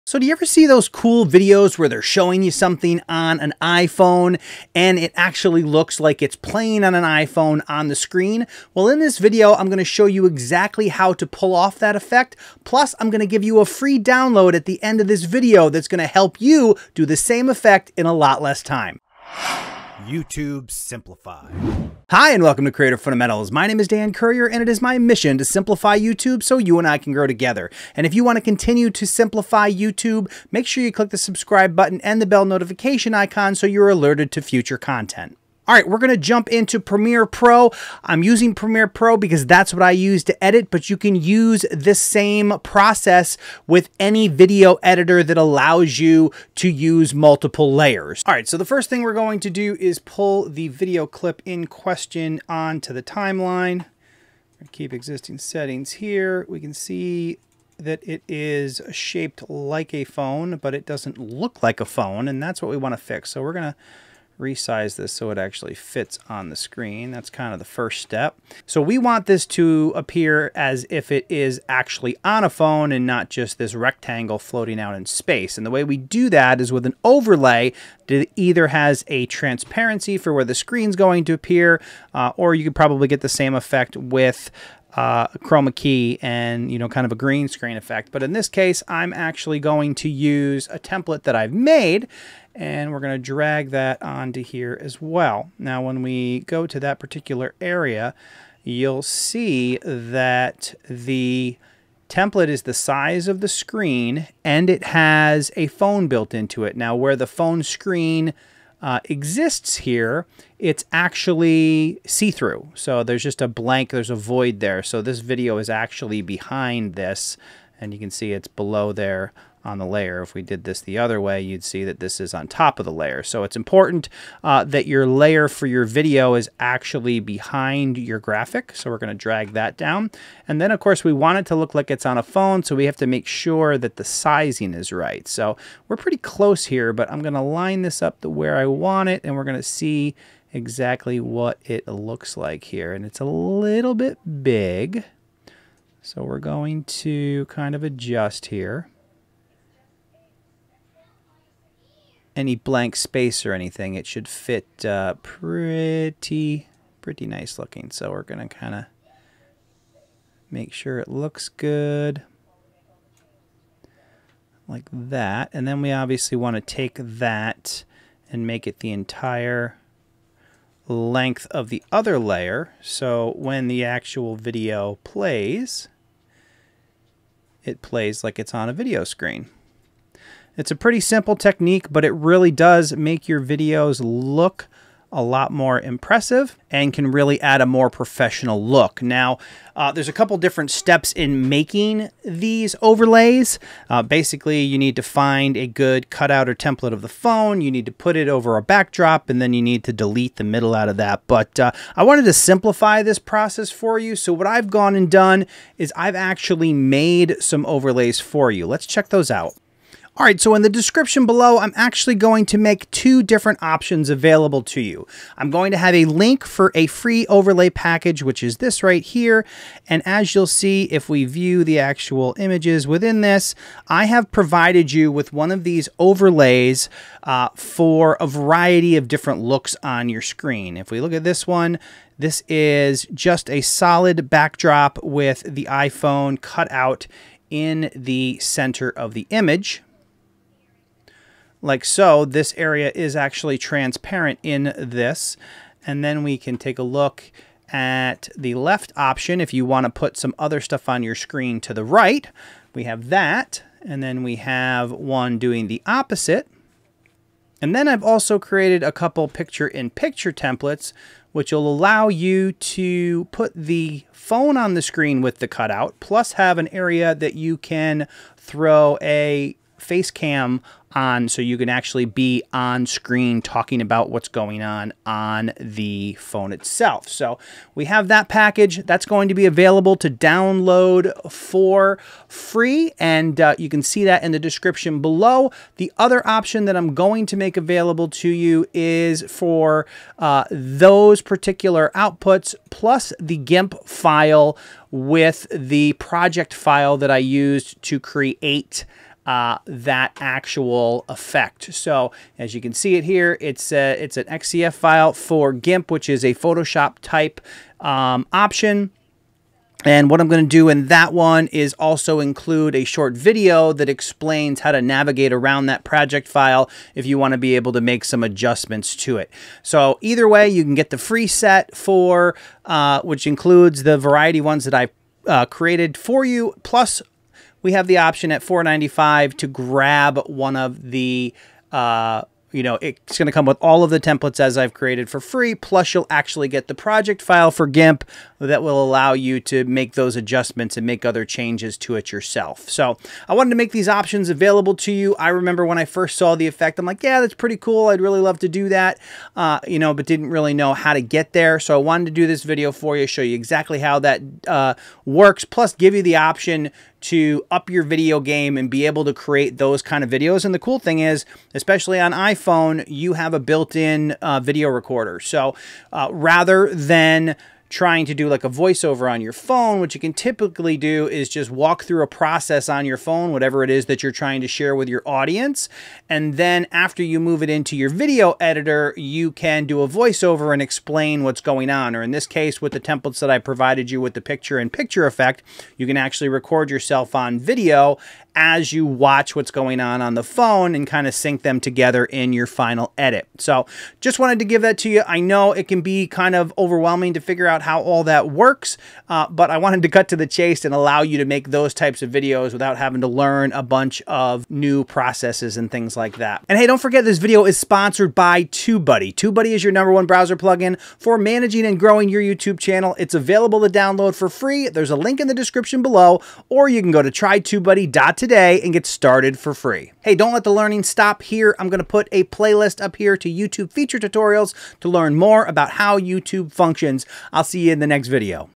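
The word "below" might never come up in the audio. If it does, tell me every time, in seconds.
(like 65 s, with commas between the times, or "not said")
118 s, 211 s, 285 s, 415 s.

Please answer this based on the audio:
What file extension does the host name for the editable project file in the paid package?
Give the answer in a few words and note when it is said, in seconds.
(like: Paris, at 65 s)
XCF, at 304 s.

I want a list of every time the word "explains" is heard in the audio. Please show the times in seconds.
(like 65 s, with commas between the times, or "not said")
313 s, 380 s.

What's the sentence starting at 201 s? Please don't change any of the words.
But uh, I wanted to simplify this process for you.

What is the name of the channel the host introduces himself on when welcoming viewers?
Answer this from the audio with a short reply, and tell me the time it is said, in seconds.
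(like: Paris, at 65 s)
Creator Fundamentals, at 22 s.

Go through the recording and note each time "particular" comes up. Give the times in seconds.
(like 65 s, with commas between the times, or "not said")
96 s, 291 s.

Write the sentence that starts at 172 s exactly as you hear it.
So when the actual video plays, it plays like it's on a video screen.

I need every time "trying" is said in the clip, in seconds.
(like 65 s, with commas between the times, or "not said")
367 s, 374 s.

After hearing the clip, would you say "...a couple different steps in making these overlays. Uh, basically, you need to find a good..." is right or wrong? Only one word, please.
right.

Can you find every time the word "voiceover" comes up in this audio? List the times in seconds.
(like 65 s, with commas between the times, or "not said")
368 s, 379 s.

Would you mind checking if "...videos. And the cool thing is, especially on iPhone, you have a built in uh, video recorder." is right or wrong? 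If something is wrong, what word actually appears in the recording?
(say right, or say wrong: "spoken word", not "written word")
right.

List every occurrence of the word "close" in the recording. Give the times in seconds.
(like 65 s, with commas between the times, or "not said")
136 s.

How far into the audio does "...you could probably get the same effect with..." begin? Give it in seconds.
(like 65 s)
82 s.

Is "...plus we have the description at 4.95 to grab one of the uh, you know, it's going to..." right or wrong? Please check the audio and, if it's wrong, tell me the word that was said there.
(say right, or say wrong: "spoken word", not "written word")
wrong: "option", not "description".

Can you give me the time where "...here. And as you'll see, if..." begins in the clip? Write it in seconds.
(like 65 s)
219 s.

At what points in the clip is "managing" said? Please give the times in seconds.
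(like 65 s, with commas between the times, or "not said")
411 s.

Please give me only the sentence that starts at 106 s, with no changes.
Now where the phone screen uh, exists here, it's actually see-through.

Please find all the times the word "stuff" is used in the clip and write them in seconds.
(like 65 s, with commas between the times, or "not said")
250 s.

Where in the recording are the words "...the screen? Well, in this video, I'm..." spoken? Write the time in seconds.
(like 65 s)
7 s.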